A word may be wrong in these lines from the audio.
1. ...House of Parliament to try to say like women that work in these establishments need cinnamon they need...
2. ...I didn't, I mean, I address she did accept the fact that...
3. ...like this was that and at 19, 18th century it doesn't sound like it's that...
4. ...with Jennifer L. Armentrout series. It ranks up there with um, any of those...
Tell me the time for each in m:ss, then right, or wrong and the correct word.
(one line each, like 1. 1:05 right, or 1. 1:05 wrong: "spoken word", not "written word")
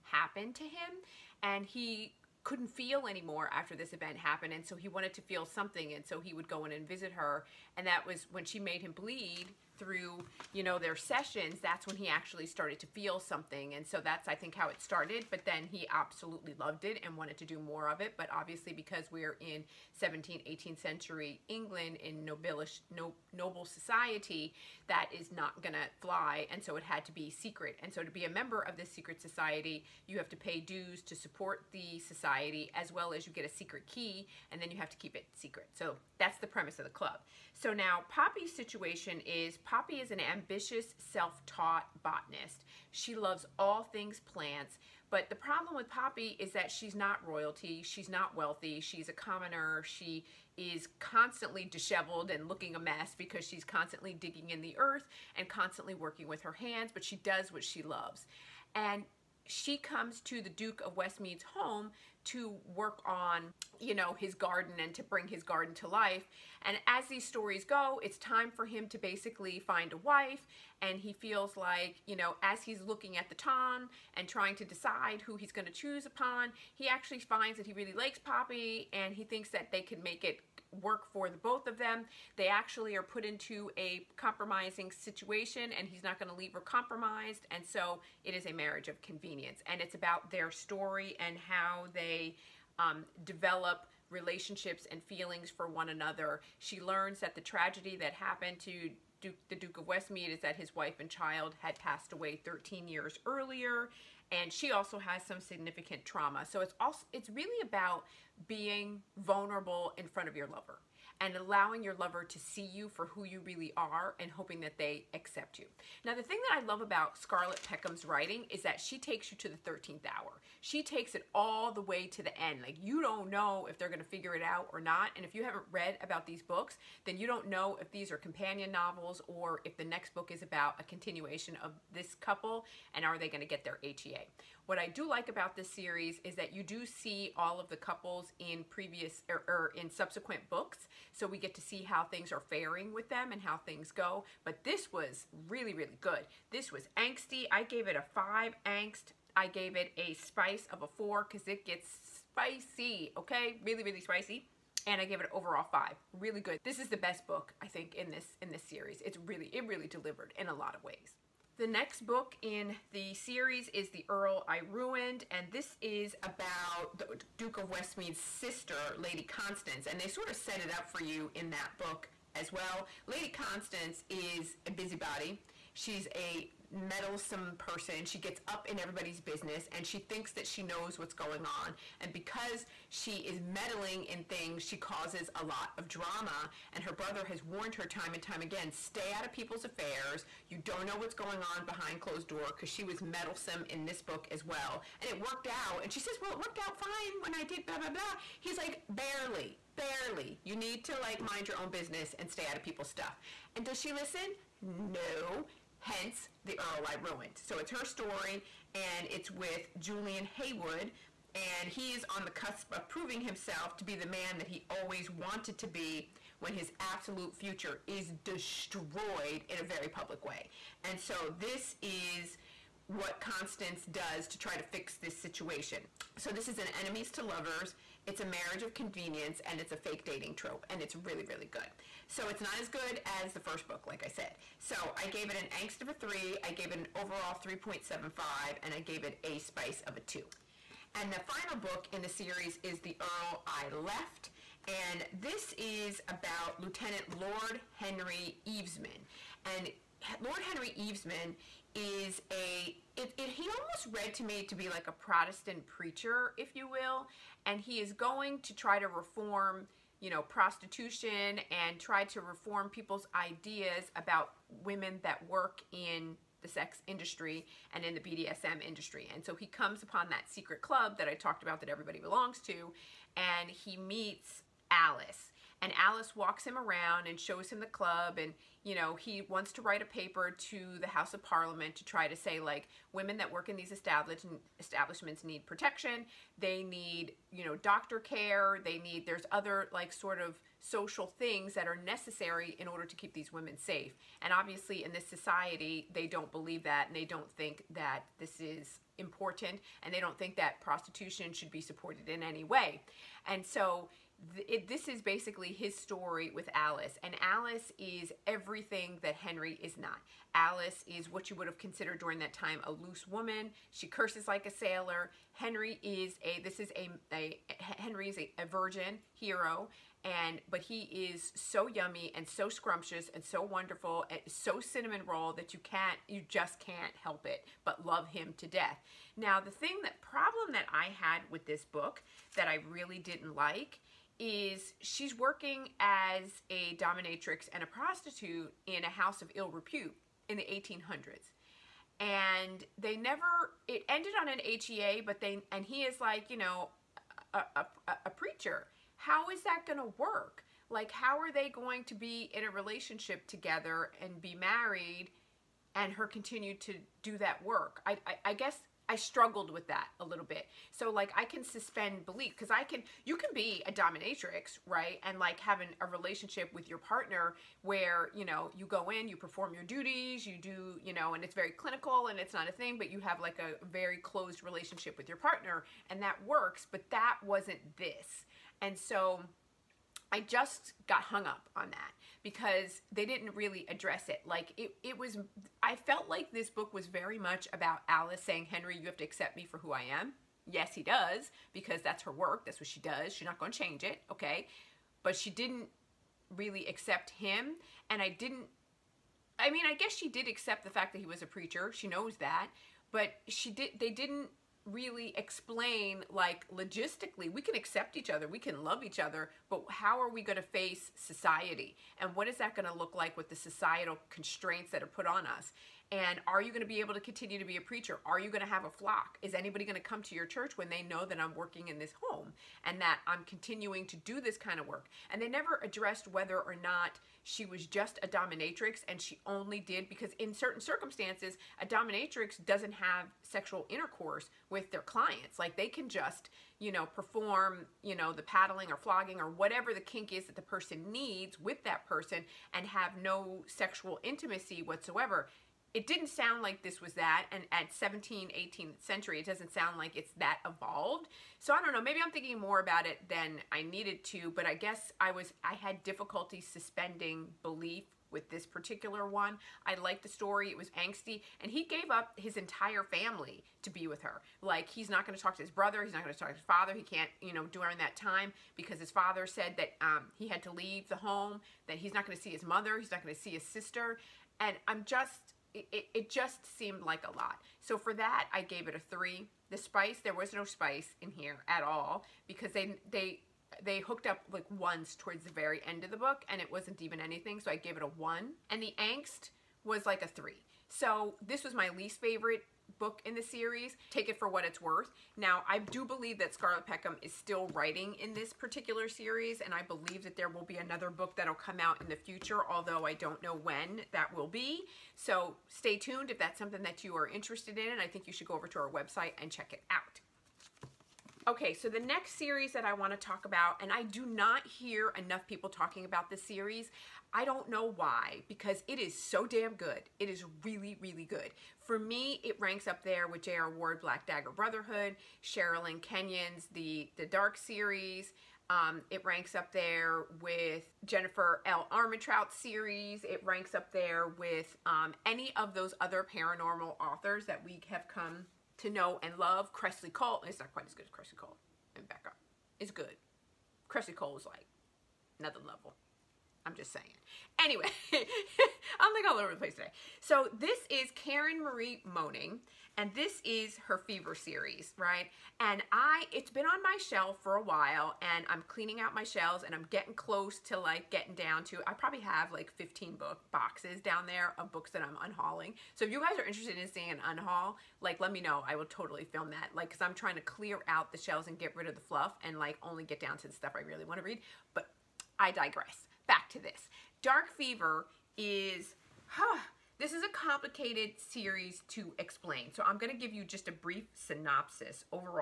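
1. 4:40 wrong: "protection", not "cinnamon"
2. 6:38 wrong: "guess", not "address"
3. 7:26 wrong: "17", not "19"
4. 8:50 right.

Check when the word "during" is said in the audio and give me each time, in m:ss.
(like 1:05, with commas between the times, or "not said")
5:11, 7:47.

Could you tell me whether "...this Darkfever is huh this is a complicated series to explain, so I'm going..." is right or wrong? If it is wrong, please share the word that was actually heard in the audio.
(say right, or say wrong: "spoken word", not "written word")
right.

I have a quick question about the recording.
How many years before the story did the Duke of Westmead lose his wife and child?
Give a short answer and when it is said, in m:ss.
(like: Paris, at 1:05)
13, at 1:42.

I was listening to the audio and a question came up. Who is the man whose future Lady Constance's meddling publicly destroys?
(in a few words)
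Julian Haywood.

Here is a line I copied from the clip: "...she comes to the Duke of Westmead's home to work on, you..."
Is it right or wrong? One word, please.
right.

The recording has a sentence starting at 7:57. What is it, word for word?
So for that, I gave it a three.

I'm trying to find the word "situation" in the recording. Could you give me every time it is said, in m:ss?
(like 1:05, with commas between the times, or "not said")
0:38, 1:24, 3:45.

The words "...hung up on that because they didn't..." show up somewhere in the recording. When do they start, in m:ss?
6:21.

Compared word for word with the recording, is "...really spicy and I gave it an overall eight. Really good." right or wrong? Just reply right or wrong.
wrong.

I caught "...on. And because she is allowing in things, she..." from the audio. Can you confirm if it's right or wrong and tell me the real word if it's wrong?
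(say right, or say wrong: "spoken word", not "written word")
wrong: "meddling", not "allowing".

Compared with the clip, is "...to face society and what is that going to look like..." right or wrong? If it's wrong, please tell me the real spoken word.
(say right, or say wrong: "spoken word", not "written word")
right.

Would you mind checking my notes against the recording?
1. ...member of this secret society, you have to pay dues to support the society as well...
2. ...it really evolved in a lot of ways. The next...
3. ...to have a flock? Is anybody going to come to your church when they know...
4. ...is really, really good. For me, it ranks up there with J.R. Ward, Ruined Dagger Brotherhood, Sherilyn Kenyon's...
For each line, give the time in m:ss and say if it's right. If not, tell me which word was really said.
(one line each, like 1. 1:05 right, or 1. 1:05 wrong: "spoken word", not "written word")
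1. 0:28 right
2. 2:39 wrong: "delivered", not "evolved"
3. 6:58 right
4. 8:40 wrong: "Black", not "Ruined".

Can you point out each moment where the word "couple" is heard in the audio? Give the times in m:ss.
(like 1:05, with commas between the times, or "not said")
2:12, 2:17.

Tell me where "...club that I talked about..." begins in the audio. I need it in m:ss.
4:30.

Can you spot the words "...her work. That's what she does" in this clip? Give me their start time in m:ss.
6:32.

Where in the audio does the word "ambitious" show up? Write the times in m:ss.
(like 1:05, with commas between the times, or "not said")
0:40.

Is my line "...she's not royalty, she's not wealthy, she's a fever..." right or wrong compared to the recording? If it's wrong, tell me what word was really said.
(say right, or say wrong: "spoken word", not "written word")
wrong: "commoner", not "fever".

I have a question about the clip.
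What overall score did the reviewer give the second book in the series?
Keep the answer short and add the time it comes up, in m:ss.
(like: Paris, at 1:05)
3.75, at 3:57.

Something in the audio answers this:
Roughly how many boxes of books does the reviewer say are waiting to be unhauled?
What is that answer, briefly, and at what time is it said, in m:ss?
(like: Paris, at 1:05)
15, at 9:22.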